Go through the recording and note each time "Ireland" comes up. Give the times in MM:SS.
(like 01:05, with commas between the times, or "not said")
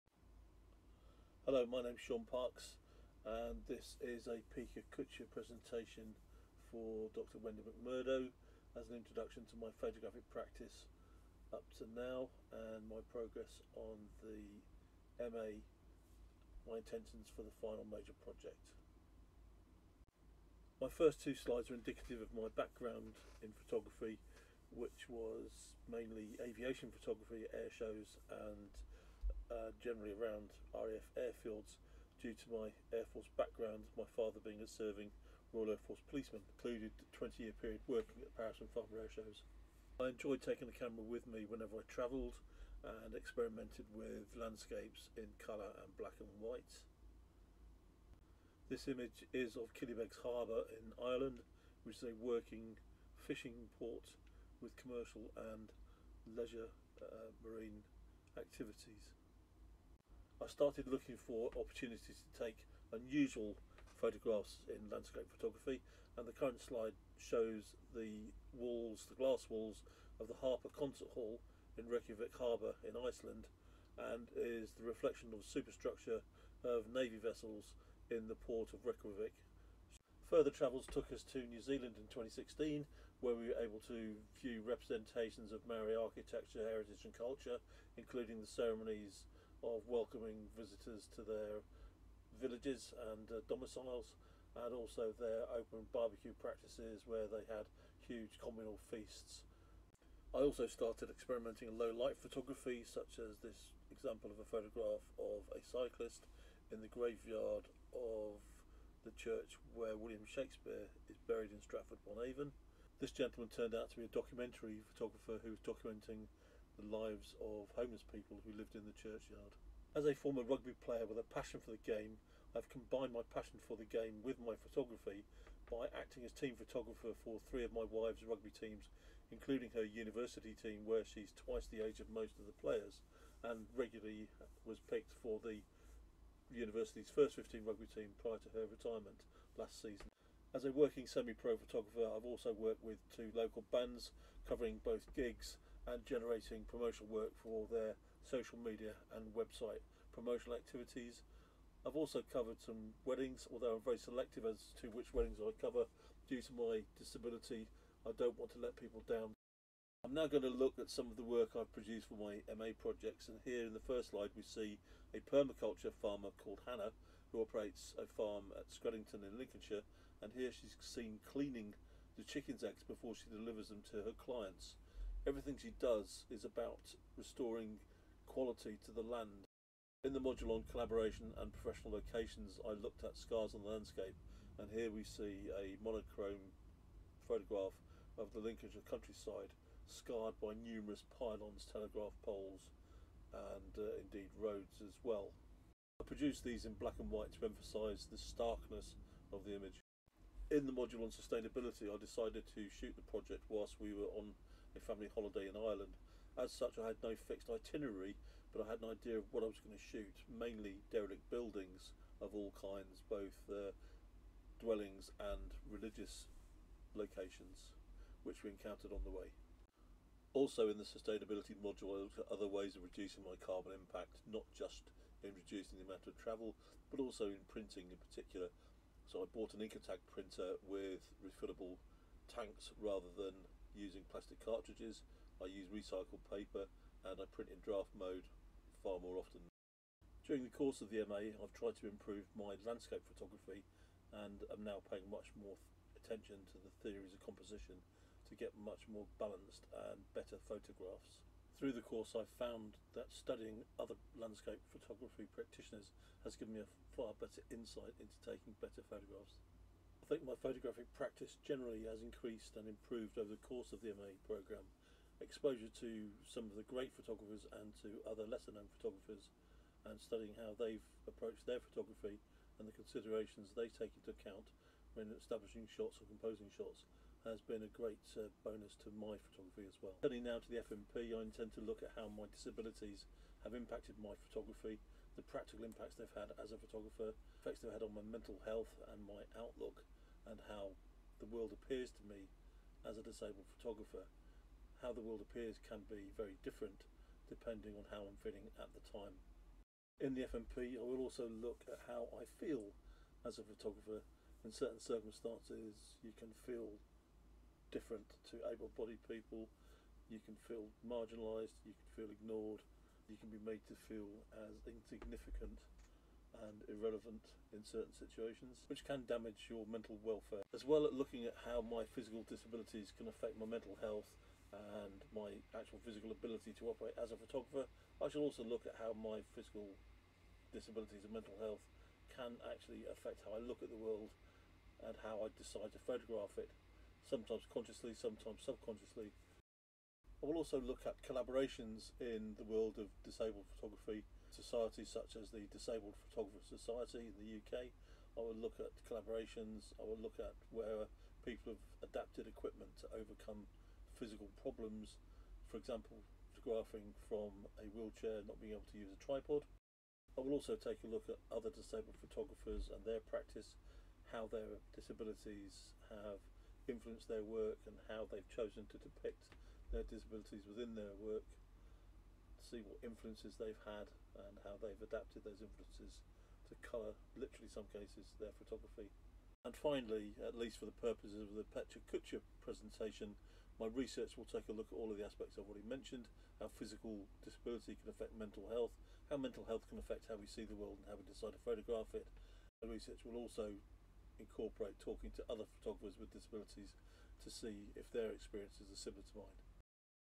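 00:50, 03:25.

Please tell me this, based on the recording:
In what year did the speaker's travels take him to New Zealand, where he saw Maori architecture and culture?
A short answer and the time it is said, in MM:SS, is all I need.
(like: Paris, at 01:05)
2016, at 01:22.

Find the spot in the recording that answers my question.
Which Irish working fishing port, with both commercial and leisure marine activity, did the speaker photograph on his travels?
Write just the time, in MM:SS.
00:49.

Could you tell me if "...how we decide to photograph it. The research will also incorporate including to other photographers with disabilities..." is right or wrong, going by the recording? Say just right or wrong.
wrong.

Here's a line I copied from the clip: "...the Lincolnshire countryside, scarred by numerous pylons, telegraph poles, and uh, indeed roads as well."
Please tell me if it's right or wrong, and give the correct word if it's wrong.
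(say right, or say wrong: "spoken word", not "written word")
right.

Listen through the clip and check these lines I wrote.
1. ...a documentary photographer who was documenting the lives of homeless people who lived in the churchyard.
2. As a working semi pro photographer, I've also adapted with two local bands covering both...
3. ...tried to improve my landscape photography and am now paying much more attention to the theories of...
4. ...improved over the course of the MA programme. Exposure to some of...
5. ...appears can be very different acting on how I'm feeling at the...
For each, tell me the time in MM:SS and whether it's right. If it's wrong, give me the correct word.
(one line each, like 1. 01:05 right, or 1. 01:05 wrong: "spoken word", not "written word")
1. 01:54 right
2. 02:20 wrong: "worked", not "adapted"
3. 04:01 right
4. 04:22 right
5. 04:55 wrong: "depending", not "acting".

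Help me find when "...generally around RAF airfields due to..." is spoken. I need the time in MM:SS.
00:29.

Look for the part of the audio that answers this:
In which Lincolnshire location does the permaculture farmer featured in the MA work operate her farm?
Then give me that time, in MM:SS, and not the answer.
02:48.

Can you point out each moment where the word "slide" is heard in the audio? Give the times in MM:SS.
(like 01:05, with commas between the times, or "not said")
00:21, 01:06, 02:44.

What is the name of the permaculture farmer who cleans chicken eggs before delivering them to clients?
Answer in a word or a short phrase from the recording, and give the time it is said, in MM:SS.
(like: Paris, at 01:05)
Hannah, at 02:46.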